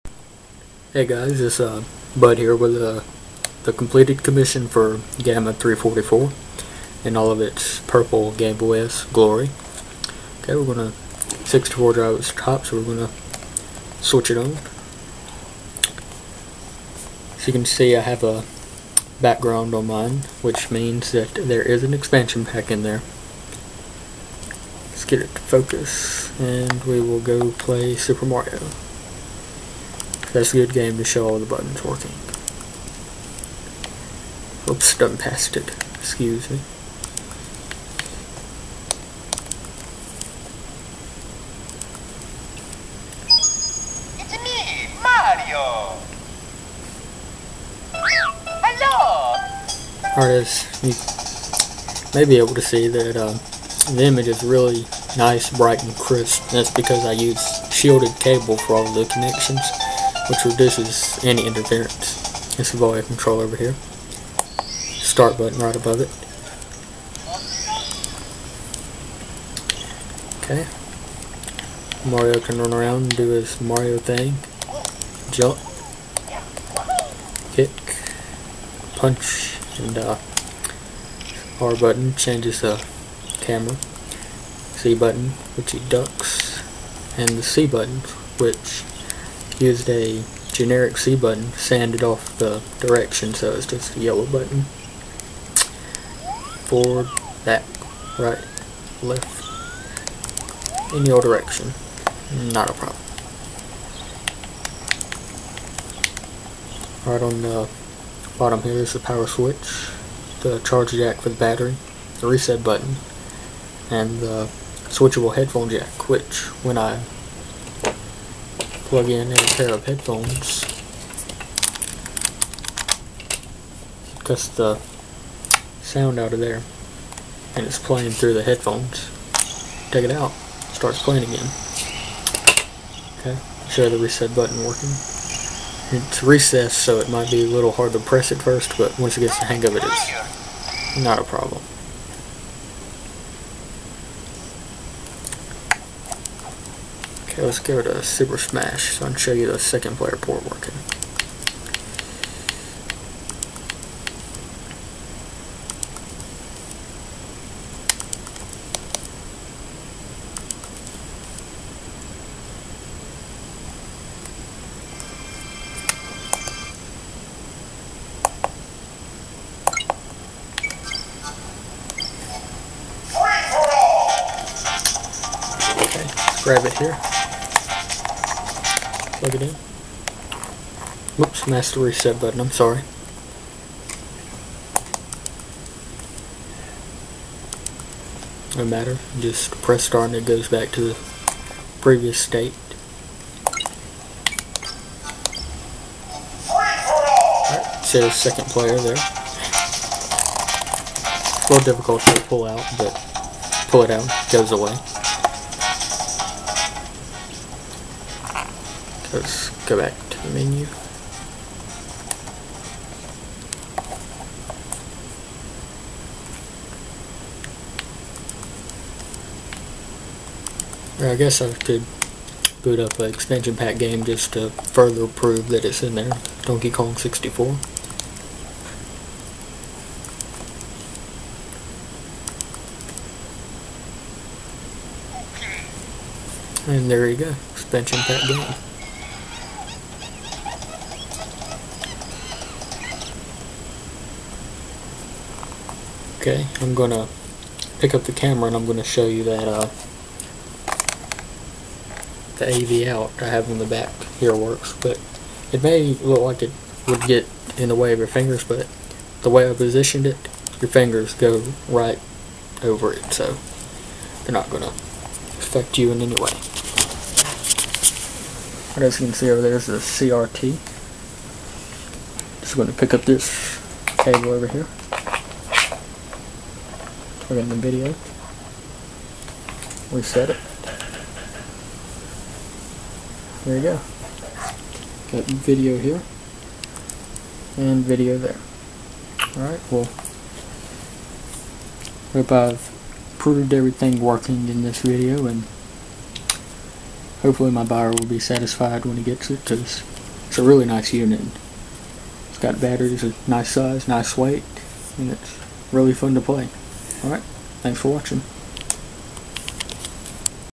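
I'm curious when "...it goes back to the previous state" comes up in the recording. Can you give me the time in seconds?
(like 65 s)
190 s.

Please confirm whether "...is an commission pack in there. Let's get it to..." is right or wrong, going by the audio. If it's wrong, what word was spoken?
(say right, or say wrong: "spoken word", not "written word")
wrong: "expansion", not "commission".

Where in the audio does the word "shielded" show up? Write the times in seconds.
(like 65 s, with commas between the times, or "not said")
57 s.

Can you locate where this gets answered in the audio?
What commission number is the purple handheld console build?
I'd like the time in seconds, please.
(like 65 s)
5 s.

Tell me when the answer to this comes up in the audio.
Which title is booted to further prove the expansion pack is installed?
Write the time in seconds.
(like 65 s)
226 s.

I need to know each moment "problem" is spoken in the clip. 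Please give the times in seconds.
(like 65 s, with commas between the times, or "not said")
102 s, 141 s.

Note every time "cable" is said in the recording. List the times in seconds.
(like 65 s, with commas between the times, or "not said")
58 s, 273 s.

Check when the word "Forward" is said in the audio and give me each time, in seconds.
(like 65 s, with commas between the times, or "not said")
96 s.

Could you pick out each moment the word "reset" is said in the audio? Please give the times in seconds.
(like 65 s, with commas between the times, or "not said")
112 s, 133 s, 181 s, 279 s.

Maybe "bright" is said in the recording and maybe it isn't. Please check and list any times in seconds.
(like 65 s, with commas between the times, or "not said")
55 s.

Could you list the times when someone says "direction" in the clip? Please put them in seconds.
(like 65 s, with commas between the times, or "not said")
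92 s, 101 s.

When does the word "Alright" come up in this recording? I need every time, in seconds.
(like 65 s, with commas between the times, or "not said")
289 s, 307 s.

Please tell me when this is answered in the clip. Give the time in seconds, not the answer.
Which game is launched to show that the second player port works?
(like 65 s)
148 s.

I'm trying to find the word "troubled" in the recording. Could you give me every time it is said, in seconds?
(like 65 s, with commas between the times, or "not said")
not said.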